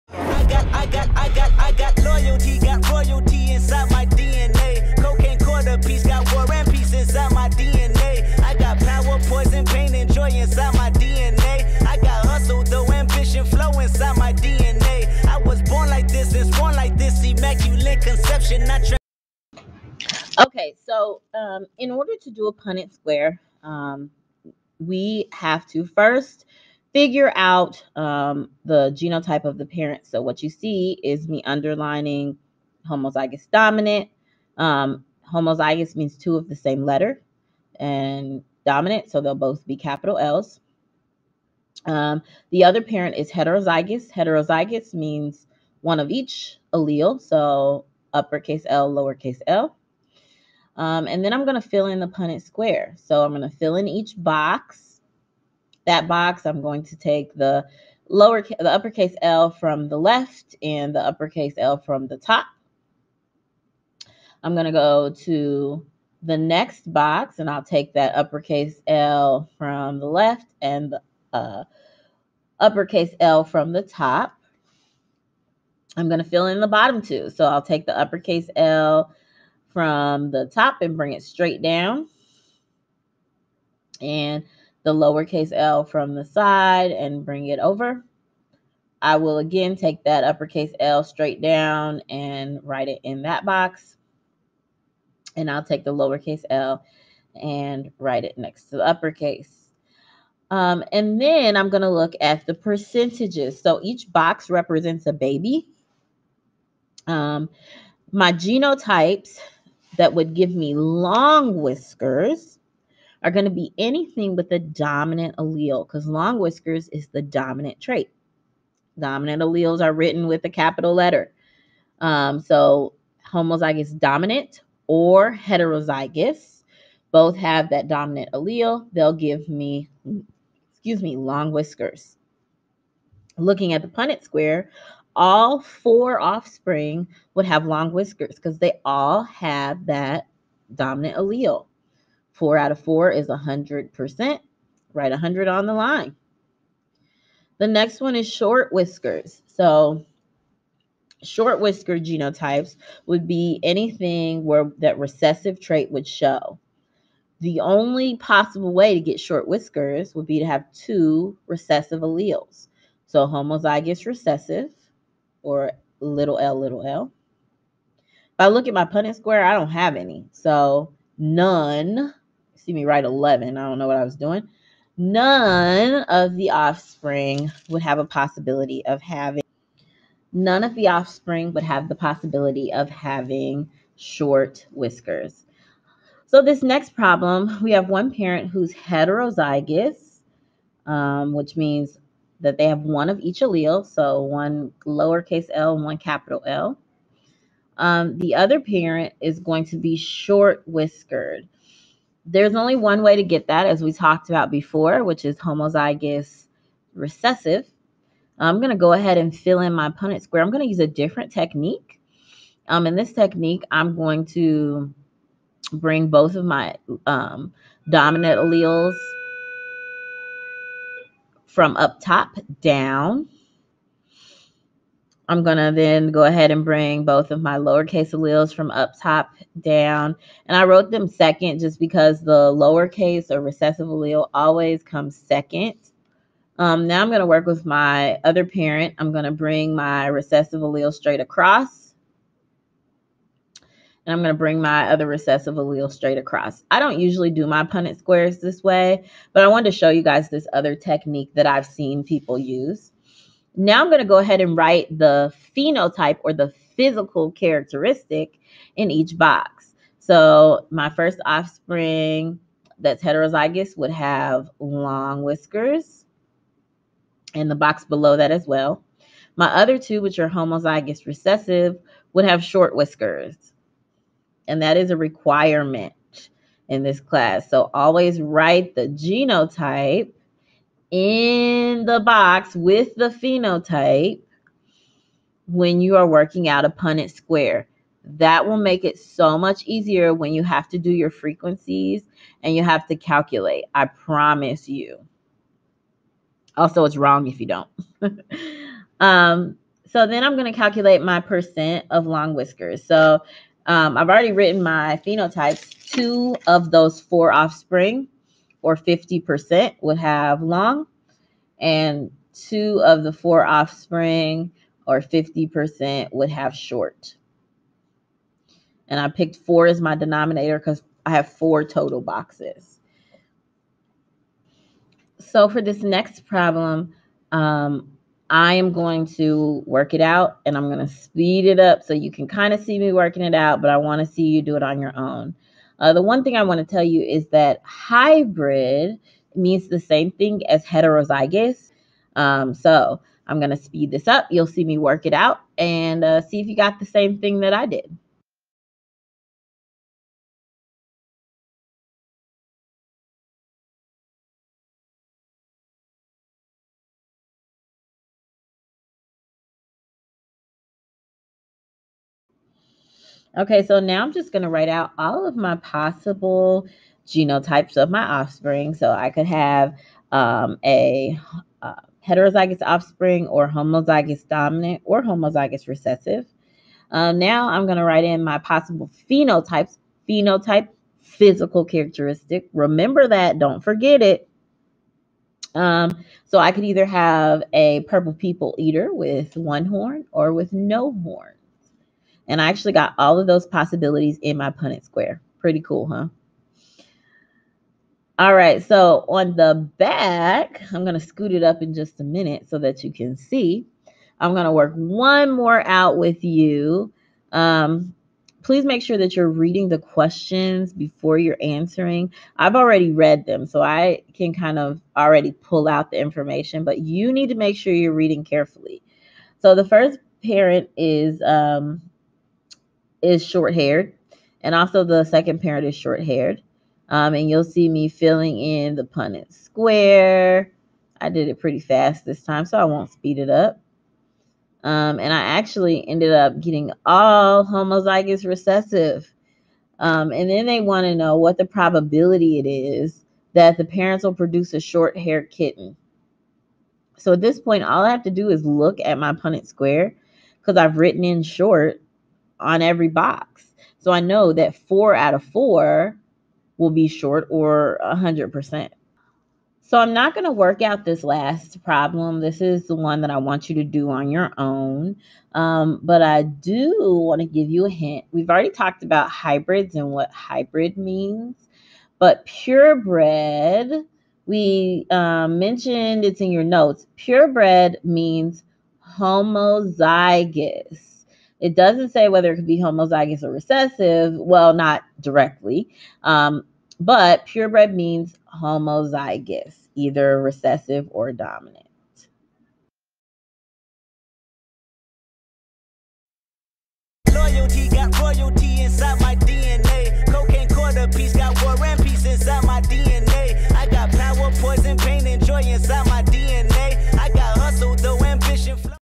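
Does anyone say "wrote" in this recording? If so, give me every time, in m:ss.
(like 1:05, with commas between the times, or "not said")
3:50.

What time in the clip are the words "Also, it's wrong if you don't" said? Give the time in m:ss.
4:56.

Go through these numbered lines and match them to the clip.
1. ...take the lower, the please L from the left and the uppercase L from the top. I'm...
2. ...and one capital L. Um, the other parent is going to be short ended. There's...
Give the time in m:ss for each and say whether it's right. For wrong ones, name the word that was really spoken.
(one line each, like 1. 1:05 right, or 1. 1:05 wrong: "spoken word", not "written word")
1. 0:56 wrong: "uppercase", not "please"
2. 3:15 wrong: "whiskered", not "ended".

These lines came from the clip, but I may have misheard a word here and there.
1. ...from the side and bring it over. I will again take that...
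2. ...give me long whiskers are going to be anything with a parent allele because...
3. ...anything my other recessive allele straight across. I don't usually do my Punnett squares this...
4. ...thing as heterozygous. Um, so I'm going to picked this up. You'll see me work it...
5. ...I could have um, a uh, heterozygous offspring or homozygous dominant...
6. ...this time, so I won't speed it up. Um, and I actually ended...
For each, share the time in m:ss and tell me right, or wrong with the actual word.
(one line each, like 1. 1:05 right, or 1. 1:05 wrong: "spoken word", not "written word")
1. 1:25 right
2. 1:50 wrong: "dominant", not "parent"
3. 4:04 wrong: "bring", not "anything"
4. 5:40 wrong: "speed", not "picked"
5. 6:08 right
6. 7:12 right.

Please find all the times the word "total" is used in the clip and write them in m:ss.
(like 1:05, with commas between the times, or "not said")
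5:21.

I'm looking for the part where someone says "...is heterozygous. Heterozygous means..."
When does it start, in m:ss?
0:43.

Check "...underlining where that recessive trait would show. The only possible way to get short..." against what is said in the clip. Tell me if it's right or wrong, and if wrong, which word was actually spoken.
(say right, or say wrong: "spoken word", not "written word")
wrong: "anything", not "underlining".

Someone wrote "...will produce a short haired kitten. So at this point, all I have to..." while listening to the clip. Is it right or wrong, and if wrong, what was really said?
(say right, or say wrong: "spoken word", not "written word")
right.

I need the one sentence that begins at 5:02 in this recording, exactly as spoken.
So um, I've already written my phenotypes.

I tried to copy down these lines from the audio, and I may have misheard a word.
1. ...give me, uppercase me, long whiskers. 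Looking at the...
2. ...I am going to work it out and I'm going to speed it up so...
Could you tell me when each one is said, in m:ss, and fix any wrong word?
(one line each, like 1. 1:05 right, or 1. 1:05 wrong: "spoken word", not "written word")
1. 2:09 wrong: "excuse", not "uppercase"
2. 5:28 right.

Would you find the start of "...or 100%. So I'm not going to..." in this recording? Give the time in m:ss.
7:37.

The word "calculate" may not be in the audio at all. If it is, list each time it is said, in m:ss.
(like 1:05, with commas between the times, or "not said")
4:52, 5:00.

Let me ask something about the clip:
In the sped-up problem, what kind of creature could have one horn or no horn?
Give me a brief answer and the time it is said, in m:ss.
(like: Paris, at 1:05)
Purple people eater, at 6:27.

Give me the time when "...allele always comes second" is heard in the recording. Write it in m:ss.
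3:53.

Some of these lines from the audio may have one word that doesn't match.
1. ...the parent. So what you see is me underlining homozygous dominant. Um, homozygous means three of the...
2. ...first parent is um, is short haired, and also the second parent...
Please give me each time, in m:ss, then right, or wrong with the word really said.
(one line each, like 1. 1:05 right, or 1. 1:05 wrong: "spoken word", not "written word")
1. 0:29 wrong: "two", not "three"
2. 6:59 right.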